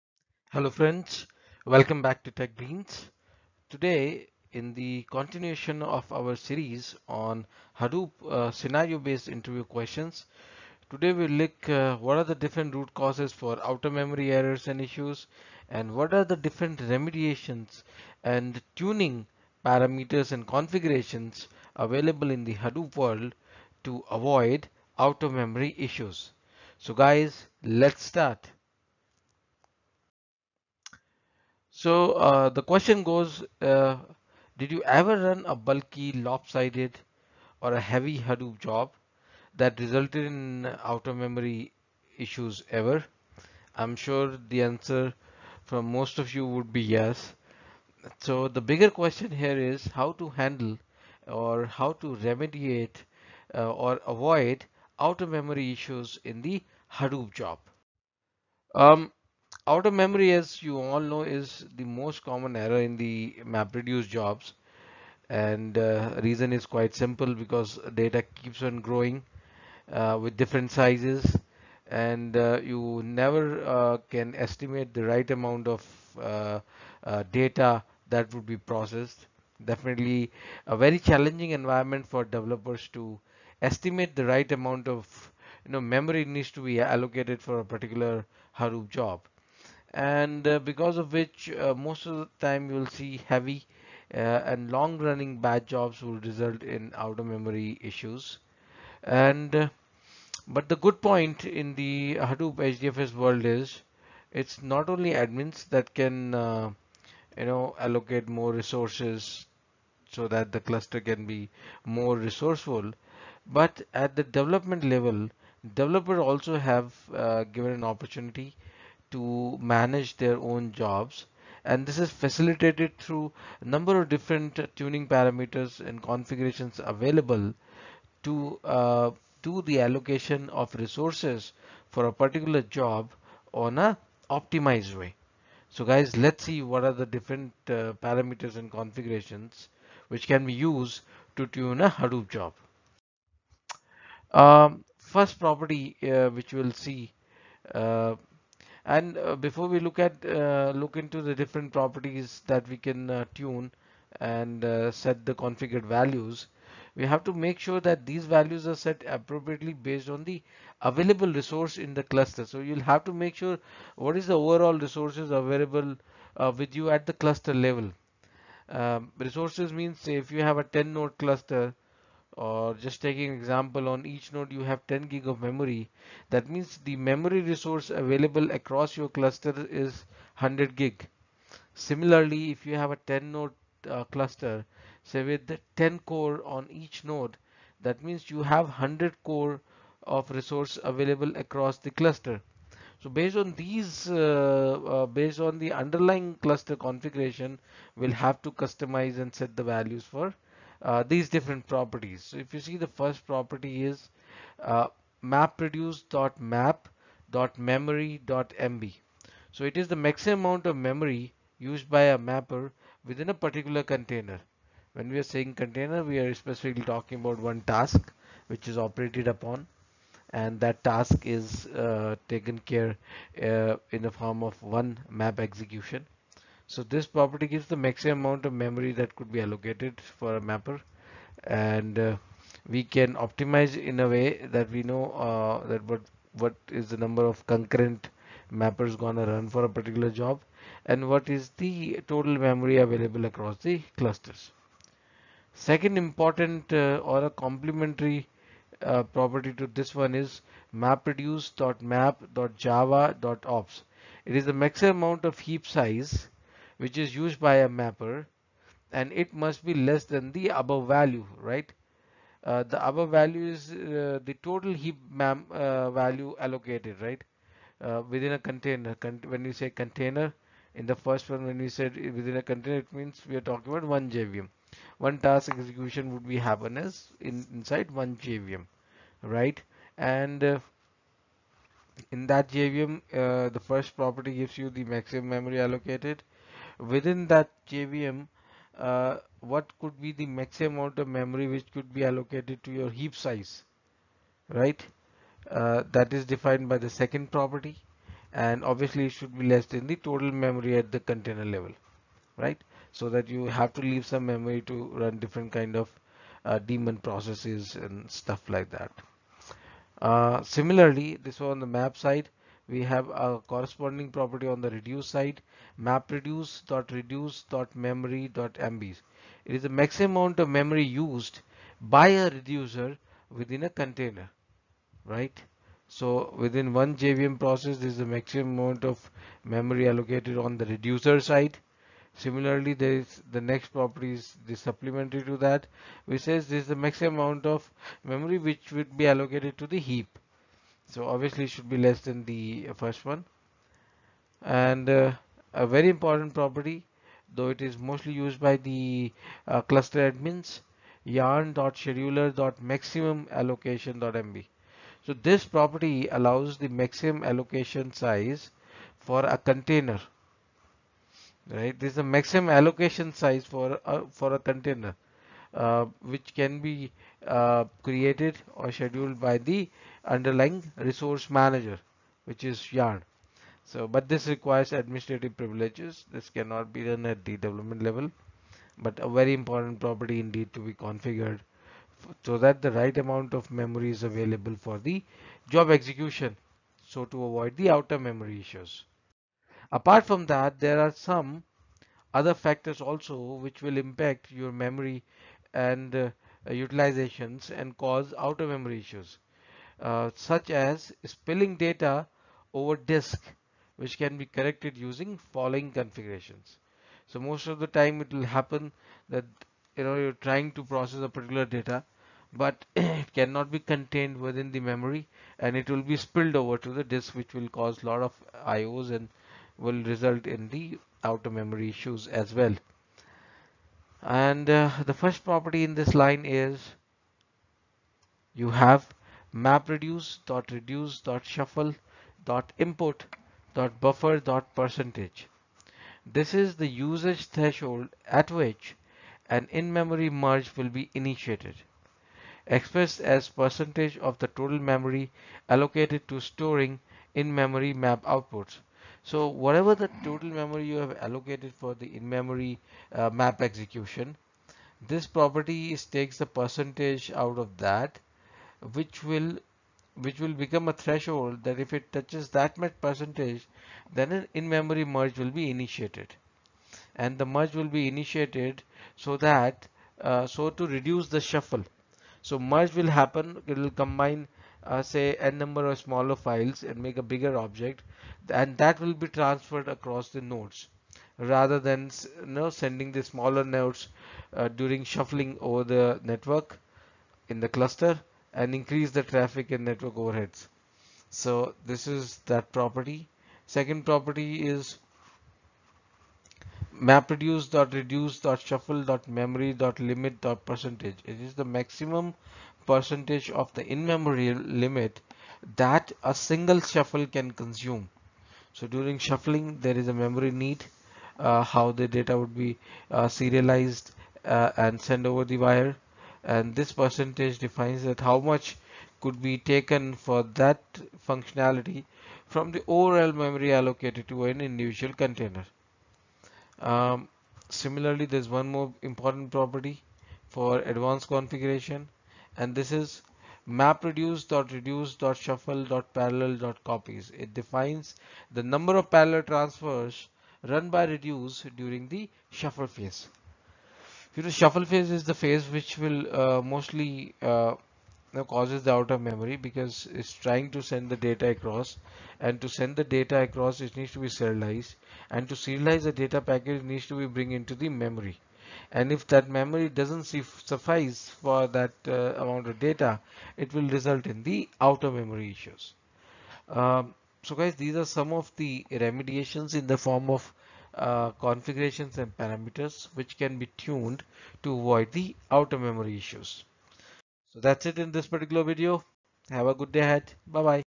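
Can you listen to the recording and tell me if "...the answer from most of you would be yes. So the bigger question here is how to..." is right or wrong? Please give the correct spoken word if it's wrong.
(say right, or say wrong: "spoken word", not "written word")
right.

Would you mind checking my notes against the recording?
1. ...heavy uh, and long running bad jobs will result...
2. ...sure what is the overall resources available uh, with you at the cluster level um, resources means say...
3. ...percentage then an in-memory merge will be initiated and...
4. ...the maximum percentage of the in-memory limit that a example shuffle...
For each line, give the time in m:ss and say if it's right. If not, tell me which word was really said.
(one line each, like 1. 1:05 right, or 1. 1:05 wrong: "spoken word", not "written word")
1. 1:33 right
2. 2:43 right
3. 7:42 right
4. 8:21 wrong: "single", not "example".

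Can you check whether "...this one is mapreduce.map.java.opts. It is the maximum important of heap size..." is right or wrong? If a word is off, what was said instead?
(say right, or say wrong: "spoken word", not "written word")
wrong: "amount", not "important".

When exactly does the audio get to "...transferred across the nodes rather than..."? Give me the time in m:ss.
7:59.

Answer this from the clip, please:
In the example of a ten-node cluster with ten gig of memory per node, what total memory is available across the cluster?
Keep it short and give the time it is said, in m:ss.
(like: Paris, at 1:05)
100 gig, at 3:00.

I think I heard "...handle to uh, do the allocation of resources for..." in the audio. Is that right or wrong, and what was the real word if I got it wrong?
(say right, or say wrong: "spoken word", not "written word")
wrong: "available", not "handle".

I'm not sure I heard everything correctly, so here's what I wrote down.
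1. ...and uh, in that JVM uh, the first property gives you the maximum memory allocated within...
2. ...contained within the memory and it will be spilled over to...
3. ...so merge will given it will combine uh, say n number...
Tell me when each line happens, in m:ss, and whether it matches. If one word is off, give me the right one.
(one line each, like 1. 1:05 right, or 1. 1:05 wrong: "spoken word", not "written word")
1. 4:39 right
2. 6:53 right
3. 7:52 wrong: "happen", not "given".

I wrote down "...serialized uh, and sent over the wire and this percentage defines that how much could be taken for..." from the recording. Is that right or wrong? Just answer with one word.
right.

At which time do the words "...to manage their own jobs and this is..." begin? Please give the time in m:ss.
1:59.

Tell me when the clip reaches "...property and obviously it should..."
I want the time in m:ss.
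4:57.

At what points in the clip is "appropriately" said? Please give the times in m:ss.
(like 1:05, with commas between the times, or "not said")
2:39.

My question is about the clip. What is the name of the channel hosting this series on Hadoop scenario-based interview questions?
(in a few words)
Tech Greens.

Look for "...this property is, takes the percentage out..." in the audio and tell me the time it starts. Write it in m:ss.
7:34.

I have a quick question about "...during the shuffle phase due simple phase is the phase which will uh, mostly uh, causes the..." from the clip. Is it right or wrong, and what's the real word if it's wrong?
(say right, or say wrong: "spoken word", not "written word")
wrong: "shuffle", not "simple".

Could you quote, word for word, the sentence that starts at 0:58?
Um, out of memory, as you all know, is the most common error in the MapReduce jobs.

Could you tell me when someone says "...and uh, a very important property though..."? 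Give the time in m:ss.
5:44.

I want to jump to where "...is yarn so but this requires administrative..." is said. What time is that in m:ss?
6:12.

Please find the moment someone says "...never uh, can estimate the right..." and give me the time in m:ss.
1:13.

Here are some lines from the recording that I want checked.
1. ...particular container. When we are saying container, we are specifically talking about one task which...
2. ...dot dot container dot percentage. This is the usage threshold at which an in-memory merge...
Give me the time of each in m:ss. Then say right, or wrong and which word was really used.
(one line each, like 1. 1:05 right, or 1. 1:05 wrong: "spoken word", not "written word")
1. 3:33 right
2. 7:12 wrong: "buffer", not "container".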